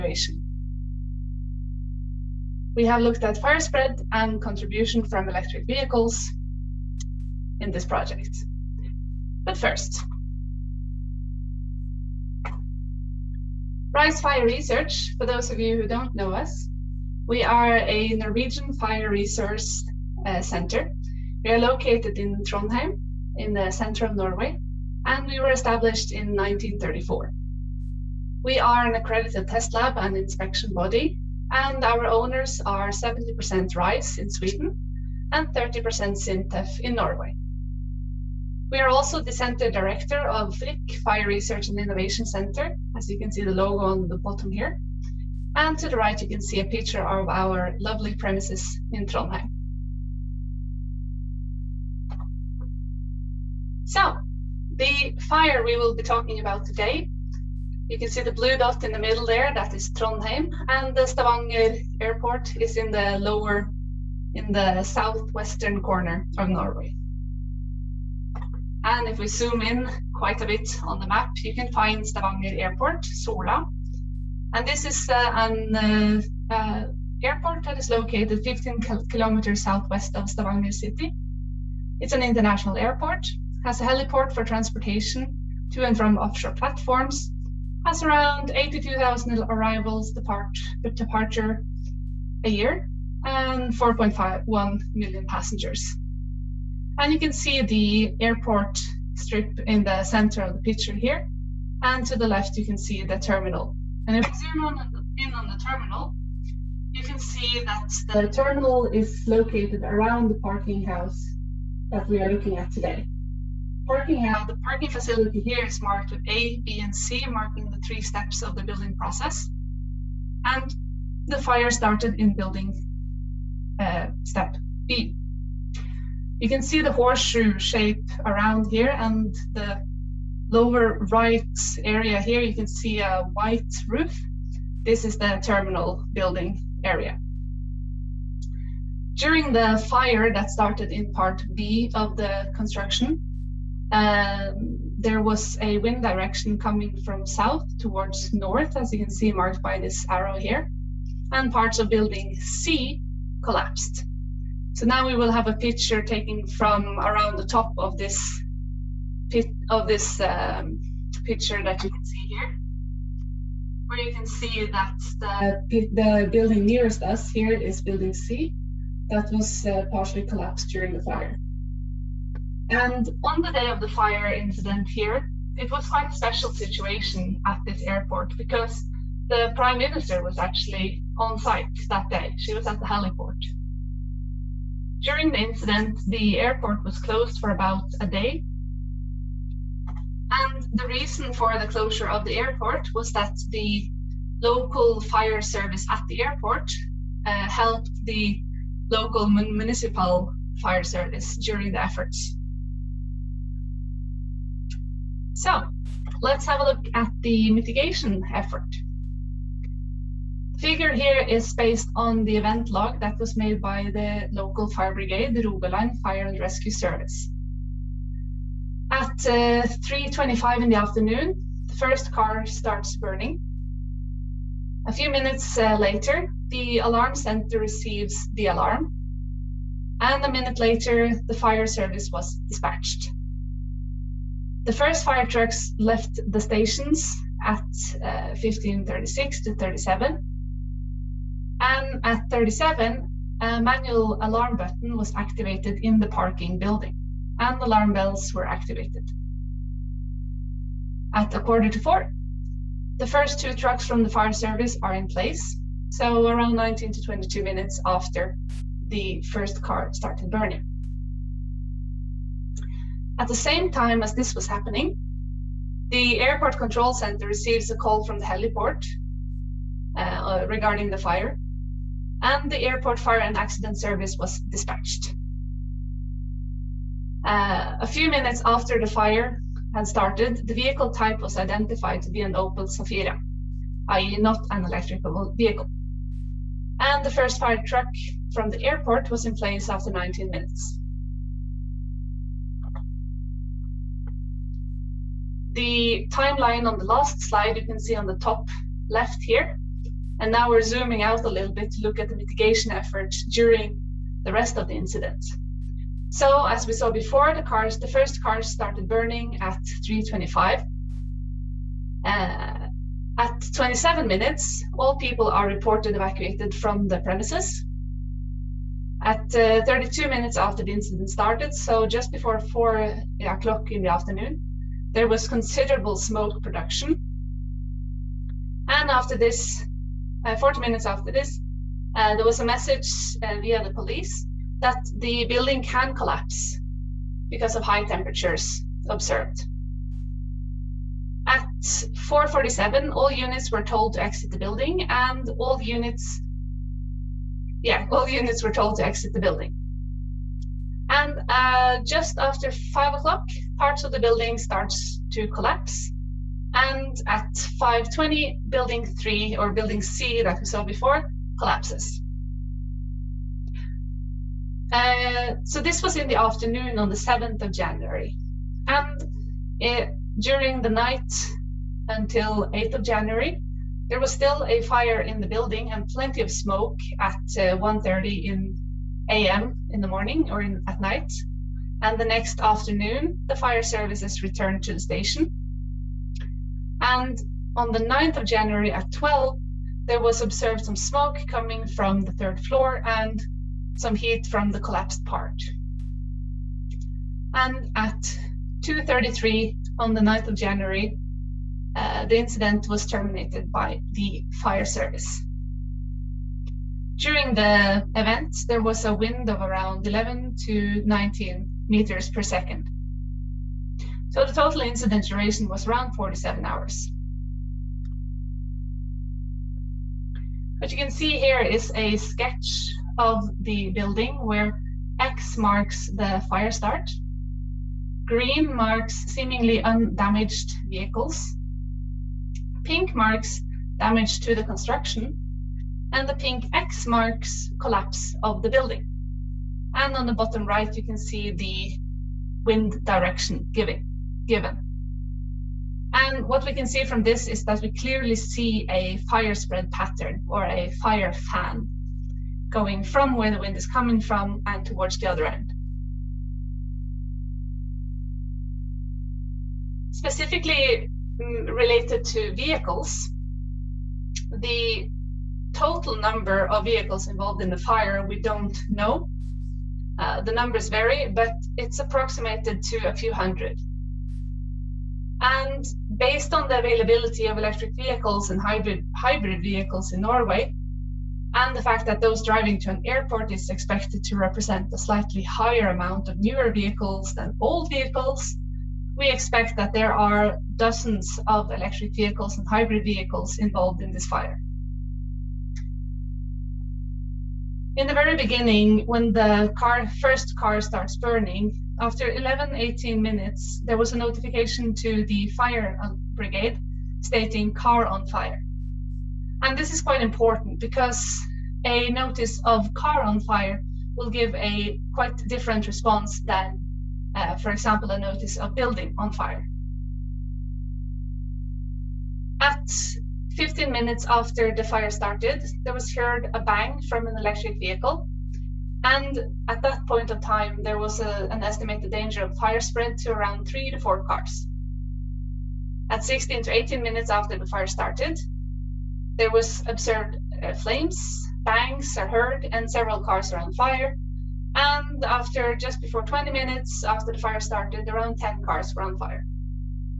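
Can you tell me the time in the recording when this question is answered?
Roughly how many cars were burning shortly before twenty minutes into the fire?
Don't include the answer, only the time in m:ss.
9:08.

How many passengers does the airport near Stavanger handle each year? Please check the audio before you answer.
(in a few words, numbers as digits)
4.51 million.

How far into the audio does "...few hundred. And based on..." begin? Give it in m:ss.
7:52.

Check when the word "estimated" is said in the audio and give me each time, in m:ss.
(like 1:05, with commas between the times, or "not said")
8:51.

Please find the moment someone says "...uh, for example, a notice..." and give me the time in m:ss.
8:37.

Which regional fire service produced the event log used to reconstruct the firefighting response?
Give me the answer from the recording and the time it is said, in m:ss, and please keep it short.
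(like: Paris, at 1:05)
Rogaland Fire and Rescue Service, at 3:35.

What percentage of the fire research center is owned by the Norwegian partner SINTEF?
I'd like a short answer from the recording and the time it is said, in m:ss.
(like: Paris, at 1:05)
30%, at 0:35.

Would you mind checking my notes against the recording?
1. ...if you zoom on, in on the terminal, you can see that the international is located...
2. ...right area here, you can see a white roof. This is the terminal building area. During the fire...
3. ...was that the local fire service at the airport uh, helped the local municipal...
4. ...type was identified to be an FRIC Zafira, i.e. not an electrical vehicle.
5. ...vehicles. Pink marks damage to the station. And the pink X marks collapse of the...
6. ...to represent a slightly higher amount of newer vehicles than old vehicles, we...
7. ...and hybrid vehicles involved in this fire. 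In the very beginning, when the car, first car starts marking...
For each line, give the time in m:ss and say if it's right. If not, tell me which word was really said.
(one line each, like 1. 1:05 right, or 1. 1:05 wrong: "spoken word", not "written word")
1. 1:44 wrong: "terminal", not "international"
2. 2:11 right
3. 3:12 right
4. 4:40 wrong: "Opel", not "FRIC"
5. 7:10 wrong: "construction", not "station"
6. 8:04 right
7. 8:12 wrong: "burning", not "marking".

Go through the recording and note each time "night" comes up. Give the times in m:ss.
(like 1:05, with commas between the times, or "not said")
6:10, 6:20.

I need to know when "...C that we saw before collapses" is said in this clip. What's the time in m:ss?
5:59.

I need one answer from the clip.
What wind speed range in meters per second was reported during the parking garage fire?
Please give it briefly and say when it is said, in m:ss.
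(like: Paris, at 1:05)
11 to 19, at 6:49.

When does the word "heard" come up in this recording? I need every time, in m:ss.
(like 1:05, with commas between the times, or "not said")
8:45, 9:02.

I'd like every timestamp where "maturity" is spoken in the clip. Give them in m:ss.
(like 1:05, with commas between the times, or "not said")
not said.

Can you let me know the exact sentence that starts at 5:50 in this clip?
And uh, just after five o'clock, parts of the building starts to collapse.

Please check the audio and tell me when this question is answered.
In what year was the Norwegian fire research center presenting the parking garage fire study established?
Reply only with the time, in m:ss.
0:26.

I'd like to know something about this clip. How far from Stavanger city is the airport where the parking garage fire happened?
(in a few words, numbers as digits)
15 kilometers.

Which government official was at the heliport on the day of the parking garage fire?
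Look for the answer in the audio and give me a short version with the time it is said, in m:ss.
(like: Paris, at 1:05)
The prime minister, at 2:59.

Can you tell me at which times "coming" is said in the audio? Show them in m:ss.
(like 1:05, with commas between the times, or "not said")
2:26, 6:31, 7:33.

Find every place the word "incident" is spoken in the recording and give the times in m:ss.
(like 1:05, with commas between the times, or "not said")
2:54, 3:05, 5:04, 5:20, 6:42, 6:54.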